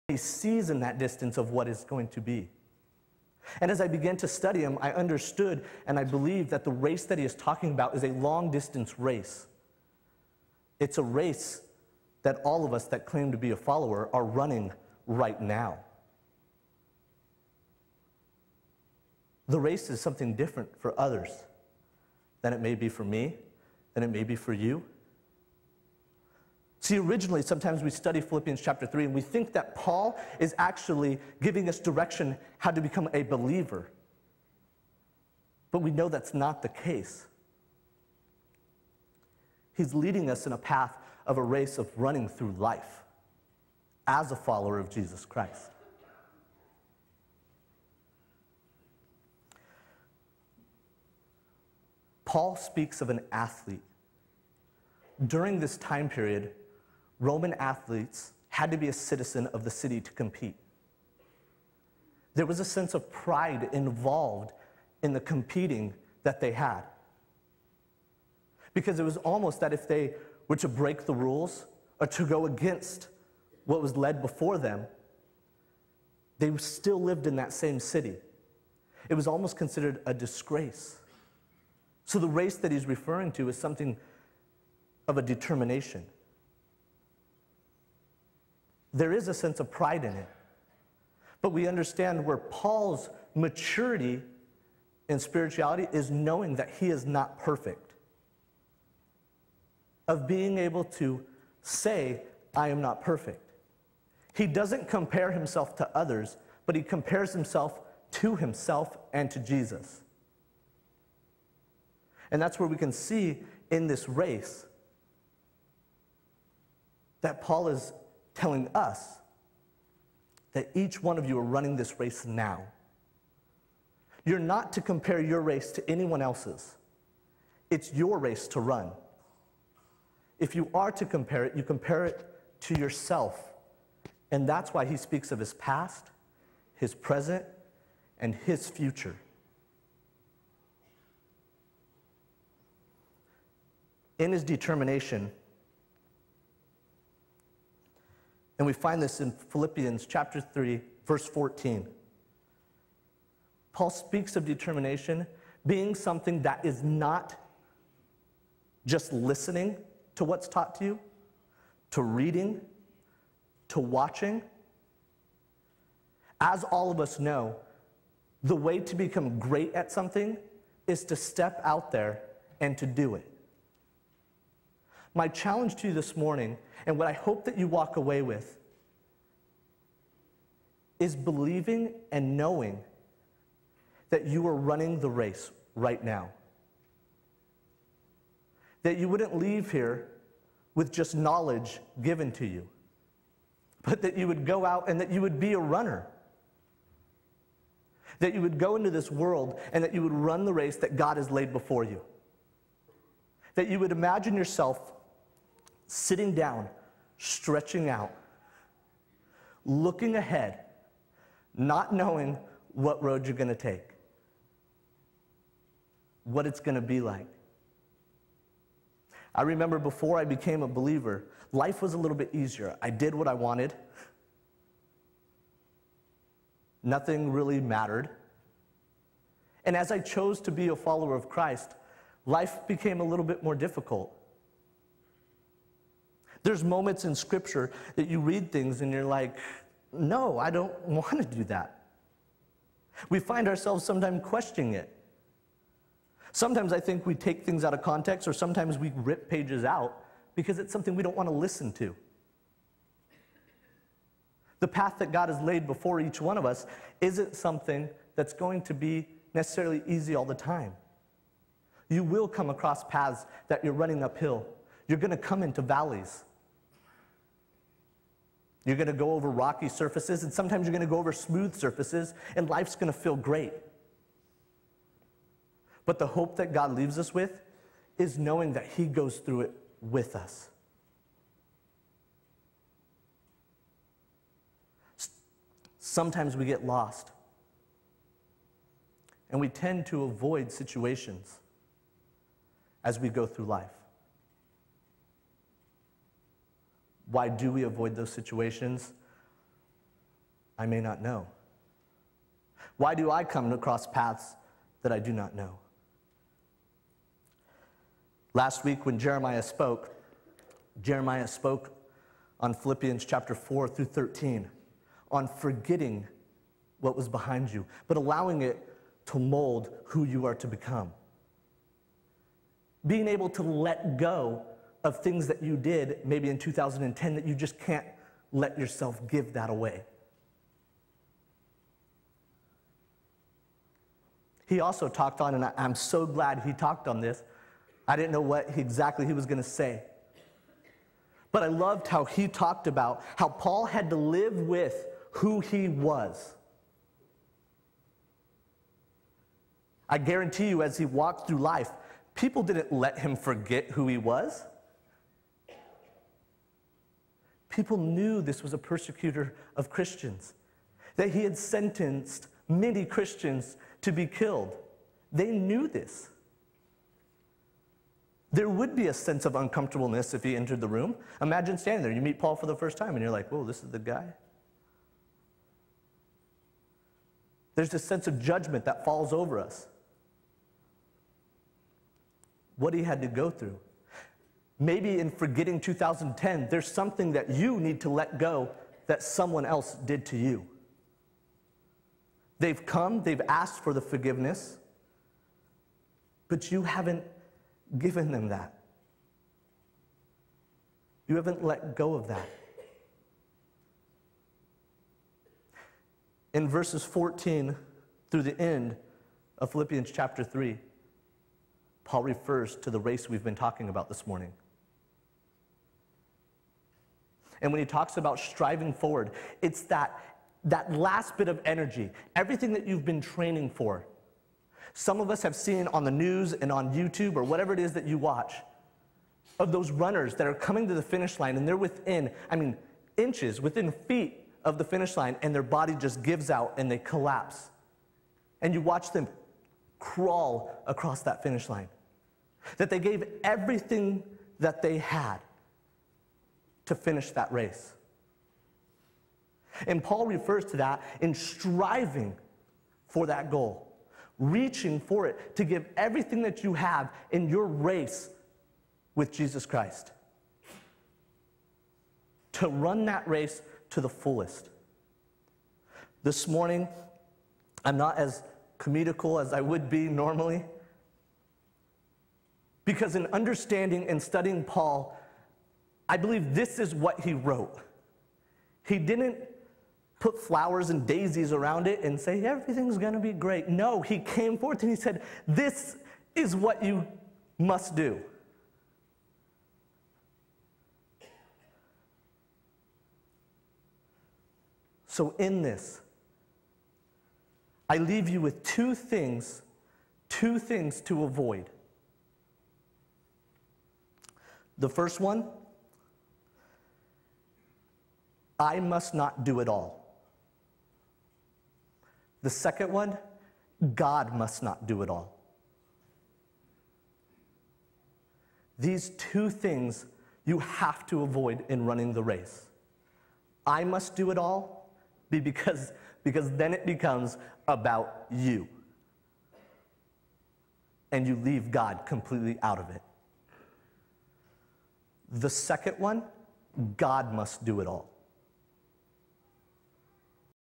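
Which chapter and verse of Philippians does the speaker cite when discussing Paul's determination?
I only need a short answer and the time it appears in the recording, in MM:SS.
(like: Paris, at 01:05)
Chapter 3, verse 14, at 02:29.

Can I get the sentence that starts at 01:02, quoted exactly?
There was a sense of pride involved in the competing that they had.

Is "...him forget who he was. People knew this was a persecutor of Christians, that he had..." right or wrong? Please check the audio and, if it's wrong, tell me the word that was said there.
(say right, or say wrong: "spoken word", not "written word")
right.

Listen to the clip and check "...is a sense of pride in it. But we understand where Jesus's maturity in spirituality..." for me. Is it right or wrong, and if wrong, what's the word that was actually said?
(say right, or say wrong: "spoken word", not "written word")
wrong: "Paul", not "Jesus".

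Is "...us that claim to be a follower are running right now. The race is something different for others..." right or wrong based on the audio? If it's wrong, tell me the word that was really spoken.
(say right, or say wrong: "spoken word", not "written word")
right.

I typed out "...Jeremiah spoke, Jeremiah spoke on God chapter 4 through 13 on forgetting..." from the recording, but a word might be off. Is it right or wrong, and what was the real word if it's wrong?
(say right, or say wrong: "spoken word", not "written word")
wrong: "Philippians", not "God".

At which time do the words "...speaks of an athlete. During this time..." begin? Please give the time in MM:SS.
00:52.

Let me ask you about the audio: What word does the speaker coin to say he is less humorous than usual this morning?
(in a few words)
Comedical.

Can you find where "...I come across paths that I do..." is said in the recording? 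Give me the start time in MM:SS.
05:03.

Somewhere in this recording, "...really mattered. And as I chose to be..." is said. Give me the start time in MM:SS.
03:47.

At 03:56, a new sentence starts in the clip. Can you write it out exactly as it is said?
There's moments in scripture that you read things and you're like, no, I don't want to do that.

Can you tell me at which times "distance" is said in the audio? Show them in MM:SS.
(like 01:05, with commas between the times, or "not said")
00:00, 00:08.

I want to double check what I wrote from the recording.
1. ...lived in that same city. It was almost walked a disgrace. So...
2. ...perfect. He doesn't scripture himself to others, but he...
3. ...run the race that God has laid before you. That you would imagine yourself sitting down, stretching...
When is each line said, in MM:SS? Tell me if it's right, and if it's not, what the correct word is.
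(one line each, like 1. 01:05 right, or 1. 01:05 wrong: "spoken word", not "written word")
1. 01:17 wrong: "considered", not "walked"
2. 01:43 wrong: "compare", not "scripture"
3. 03:20 right.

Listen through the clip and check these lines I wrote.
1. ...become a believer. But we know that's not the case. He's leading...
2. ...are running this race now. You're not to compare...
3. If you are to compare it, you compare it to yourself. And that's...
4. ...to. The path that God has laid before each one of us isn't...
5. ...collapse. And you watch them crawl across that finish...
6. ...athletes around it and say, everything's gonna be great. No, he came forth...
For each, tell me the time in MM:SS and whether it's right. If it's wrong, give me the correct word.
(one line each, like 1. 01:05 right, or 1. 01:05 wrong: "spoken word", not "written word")
1. 00:32 right
2. 02:01 right
3. 02:10 right
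4. 04:11 right
5. 07:16 right
6. 08:00 wrong: "daisies", not "athletes".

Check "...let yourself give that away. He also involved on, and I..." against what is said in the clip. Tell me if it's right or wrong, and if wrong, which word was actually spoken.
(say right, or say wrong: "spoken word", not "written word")
wrong: "talked", not "involved".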